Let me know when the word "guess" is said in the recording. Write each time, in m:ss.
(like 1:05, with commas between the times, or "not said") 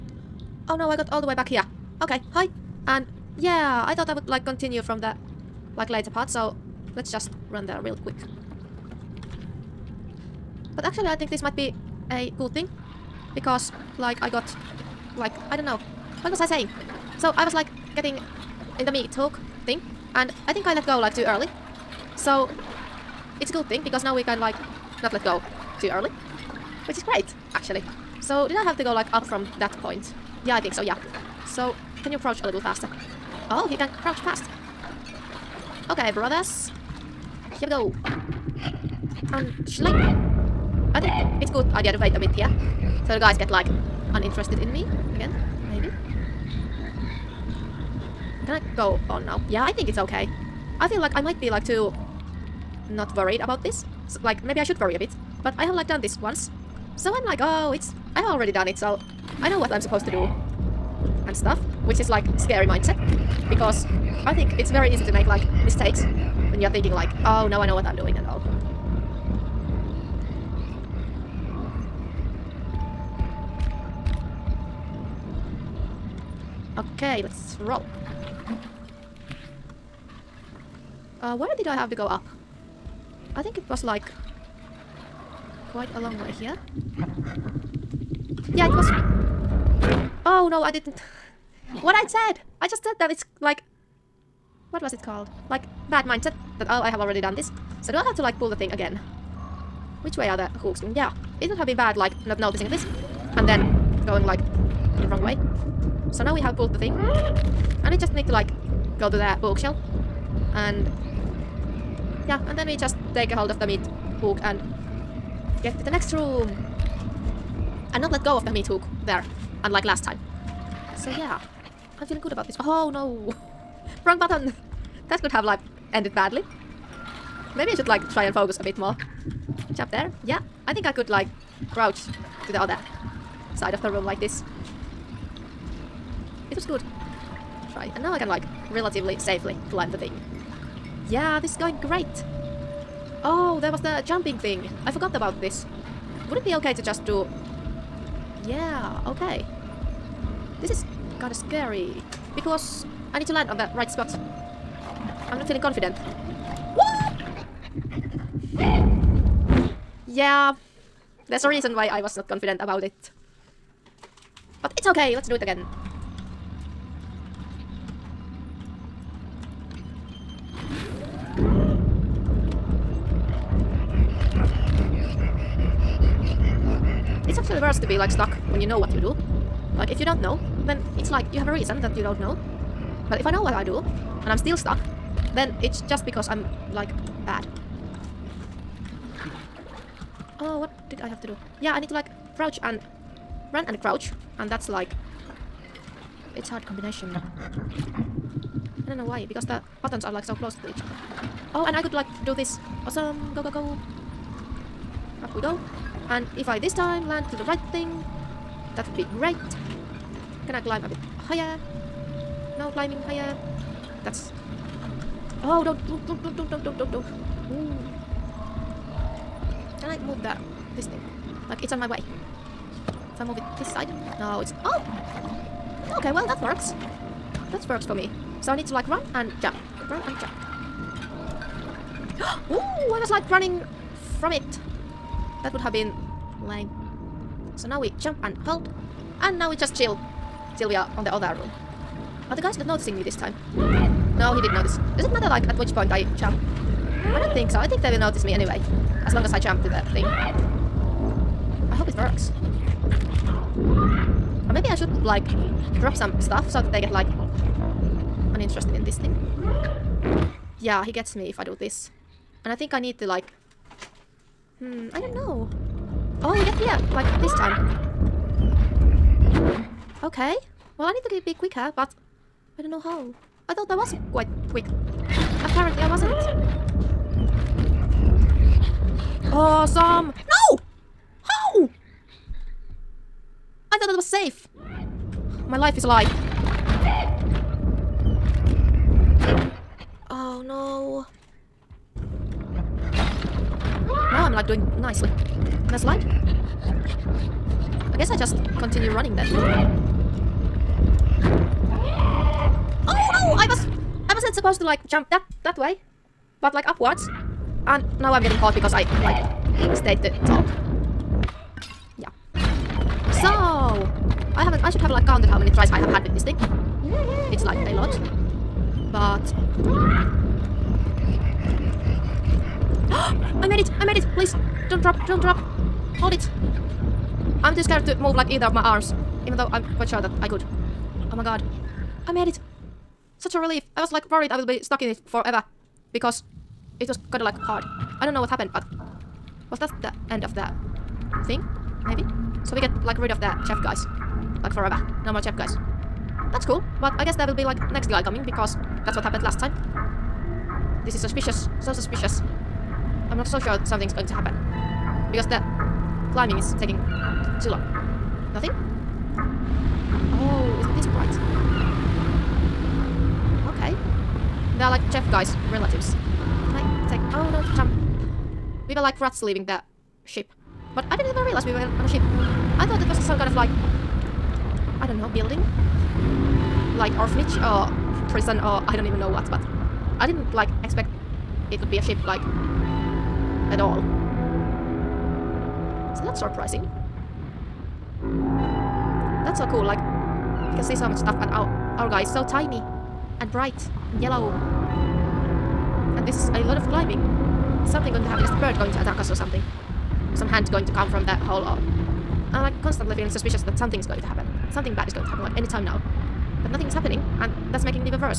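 4:57, 5:47.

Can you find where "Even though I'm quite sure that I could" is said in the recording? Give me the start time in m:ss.
5:29.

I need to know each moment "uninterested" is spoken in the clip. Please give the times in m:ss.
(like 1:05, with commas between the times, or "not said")
0:44, 4:18.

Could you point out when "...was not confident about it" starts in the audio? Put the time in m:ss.
2:42.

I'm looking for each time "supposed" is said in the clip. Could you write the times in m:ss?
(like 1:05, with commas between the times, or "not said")
0:59, 5:04.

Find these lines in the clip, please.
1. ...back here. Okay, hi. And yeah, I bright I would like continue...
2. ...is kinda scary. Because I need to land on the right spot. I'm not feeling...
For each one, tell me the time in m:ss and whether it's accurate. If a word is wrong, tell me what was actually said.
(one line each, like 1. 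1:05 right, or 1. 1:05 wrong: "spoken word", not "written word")
1. 0:01 wrong: "thought", not "bright"
2. 2:30 right.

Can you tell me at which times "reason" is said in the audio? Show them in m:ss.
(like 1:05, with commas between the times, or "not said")
2:41, 3:01.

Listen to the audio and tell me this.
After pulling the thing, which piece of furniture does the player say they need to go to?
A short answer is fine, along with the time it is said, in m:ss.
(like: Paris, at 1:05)
bookshelf, at 1:49.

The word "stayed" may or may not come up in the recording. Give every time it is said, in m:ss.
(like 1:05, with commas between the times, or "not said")
5:09.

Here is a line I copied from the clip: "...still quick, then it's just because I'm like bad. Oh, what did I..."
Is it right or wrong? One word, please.
wrong.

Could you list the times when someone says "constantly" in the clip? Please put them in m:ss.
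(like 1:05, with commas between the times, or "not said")
6:42.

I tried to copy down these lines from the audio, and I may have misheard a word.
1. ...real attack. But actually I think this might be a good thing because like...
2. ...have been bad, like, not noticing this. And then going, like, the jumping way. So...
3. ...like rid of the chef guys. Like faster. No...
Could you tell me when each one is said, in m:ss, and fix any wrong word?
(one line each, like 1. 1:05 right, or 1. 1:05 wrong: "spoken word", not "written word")
1. 0:07 wrong: "quick", not "attack"
2. 1:41 wrong: "wrong", not "jumping"
3. 5:42 wrong: "forever", not "faster".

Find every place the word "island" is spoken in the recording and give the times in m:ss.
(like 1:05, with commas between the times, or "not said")
not said.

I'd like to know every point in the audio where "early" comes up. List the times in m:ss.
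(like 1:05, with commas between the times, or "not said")
0:21, 0:25.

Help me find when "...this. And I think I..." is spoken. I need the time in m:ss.
4:21.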